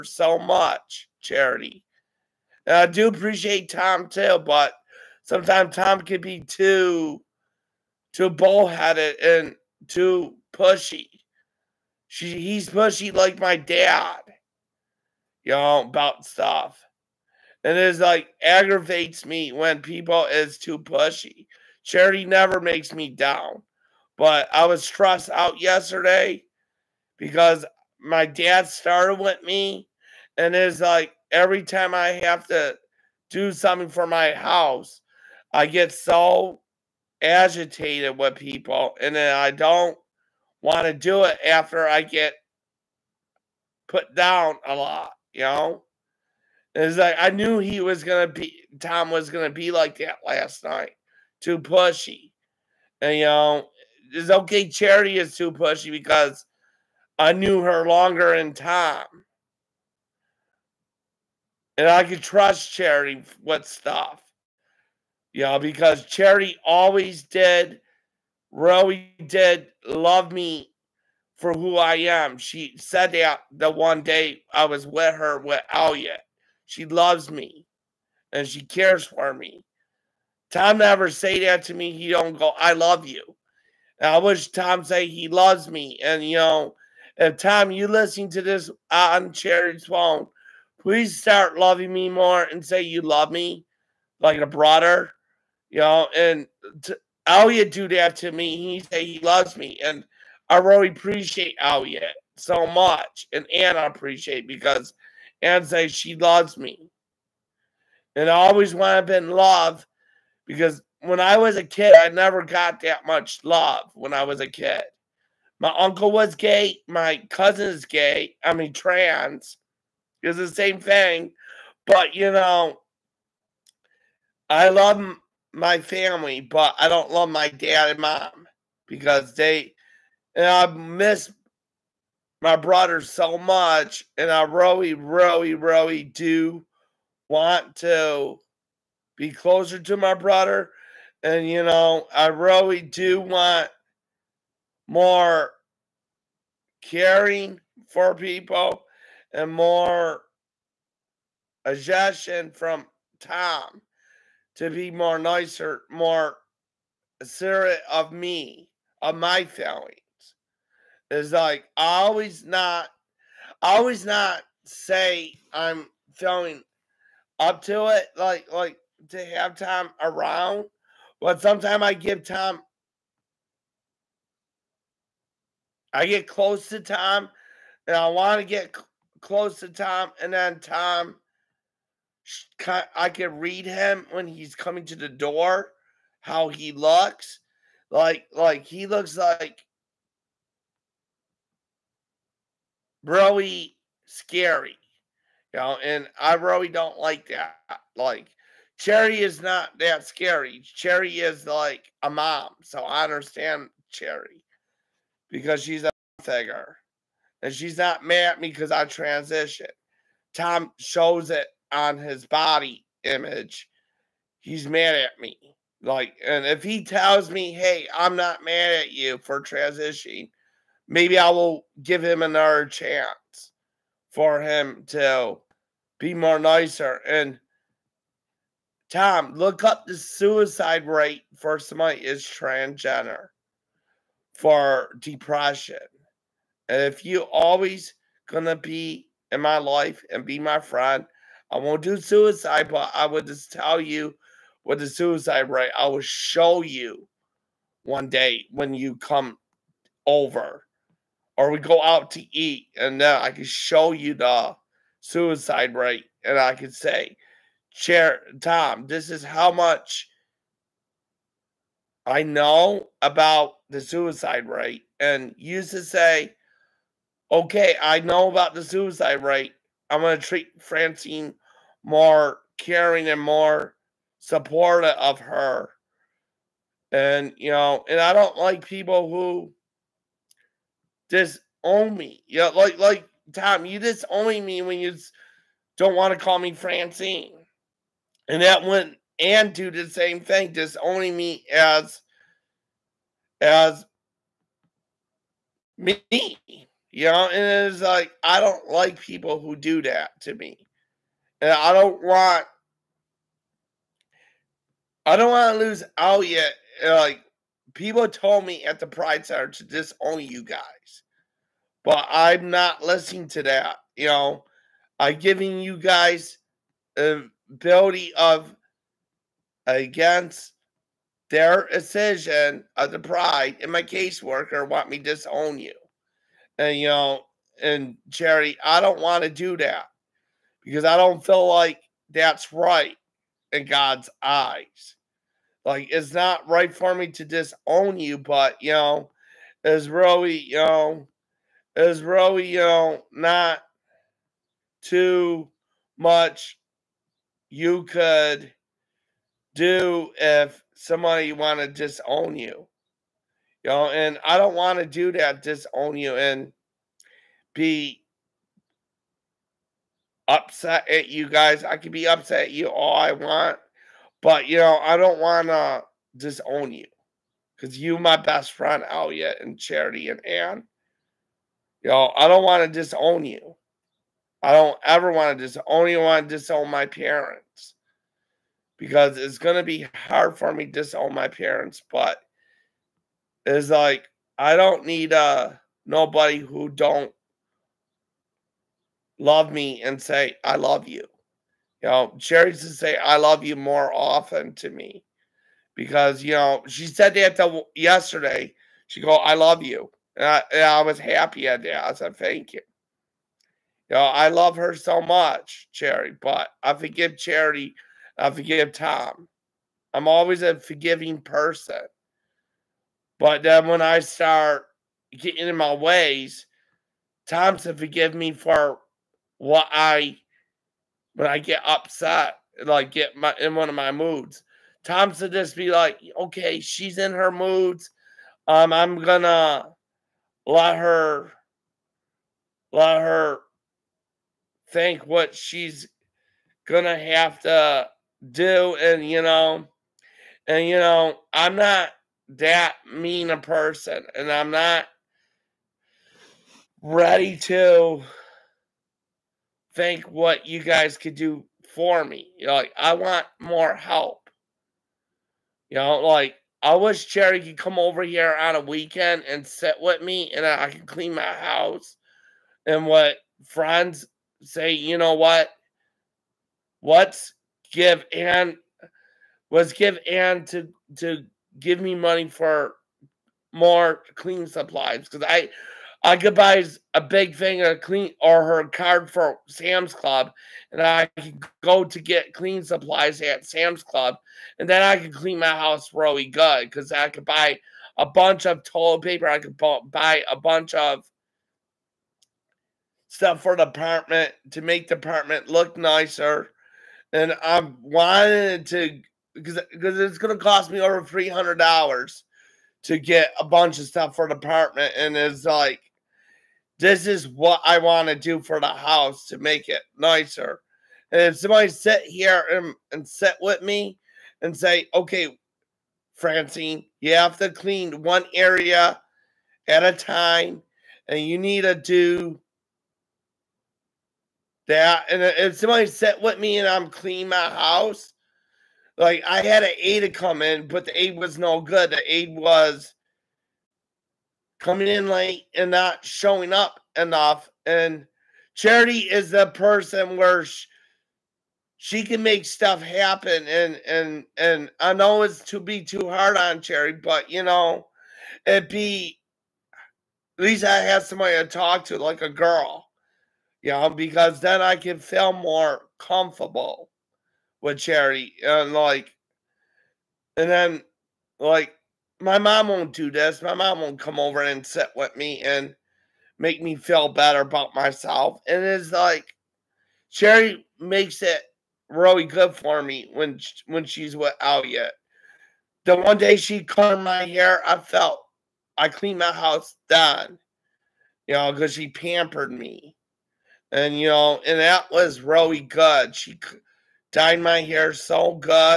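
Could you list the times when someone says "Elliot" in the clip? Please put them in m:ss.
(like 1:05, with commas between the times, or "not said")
1:15, 6:08.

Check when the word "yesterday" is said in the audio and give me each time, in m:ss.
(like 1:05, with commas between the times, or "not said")
0:25, 6:37.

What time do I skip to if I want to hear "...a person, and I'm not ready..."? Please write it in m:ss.
7:23.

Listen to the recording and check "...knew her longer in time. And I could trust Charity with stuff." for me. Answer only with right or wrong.
right.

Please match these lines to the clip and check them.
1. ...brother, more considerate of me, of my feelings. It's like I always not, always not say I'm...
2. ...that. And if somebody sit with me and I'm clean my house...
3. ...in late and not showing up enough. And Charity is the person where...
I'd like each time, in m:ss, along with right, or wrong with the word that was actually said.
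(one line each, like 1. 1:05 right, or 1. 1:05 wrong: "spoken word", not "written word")
1. 2:35 wrong: "nicer", not "brother"
2. 8:44 right
3. 8:54 right.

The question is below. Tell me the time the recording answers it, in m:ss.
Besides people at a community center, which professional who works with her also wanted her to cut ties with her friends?
5:23.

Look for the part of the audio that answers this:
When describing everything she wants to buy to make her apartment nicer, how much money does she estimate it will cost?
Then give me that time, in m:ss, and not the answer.
8:20.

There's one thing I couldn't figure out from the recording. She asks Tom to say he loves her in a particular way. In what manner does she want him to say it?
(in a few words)
like a brother.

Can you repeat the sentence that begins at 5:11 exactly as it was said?
But I'm not listening to that.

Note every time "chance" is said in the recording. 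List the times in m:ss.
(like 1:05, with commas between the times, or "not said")
3:42.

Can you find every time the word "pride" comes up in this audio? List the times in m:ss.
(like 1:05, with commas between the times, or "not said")
5:08, 5:22.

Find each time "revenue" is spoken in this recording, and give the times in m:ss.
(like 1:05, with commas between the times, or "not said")
not said.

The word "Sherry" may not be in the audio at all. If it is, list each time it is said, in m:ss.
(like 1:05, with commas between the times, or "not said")
6:32.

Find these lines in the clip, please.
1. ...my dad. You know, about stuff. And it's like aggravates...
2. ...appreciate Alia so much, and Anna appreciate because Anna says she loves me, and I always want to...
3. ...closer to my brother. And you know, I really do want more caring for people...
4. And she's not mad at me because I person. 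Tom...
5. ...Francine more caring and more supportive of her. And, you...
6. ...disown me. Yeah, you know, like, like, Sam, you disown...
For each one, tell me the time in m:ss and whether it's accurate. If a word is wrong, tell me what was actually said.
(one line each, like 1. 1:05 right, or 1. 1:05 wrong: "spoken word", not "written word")
1. 0:13 right
2. 1:40 right
3. 2:19 right
4. 3:27 wrong: "transition", not "person"
5. 4:30 right
6. 4:41 wrong: "Tom", not "Sam".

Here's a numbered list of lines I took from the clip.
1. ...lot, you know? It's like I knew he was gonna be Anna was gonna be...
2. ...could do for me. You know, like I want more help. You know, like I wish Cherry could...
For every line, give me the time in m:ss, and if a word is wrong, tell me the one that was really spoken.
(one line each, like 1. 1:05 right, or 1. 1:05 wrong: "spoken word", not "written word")
1. 0:44 wrong: "Tom", not "Anna"
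2. 7:30 right.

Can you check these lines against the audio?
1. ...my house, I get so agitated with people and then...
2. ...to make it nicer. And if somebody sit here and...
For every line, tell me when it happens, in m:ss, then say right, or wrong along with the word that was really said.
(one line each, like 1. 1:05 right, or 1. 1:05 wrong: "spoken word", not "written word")
1. 0:34 right
2. 8:29 right.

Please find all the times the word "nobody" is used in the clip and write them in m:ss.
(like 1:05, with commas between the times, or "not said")
6:25.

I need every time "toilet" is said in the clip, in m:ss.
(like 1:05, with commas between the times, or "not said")
8:08.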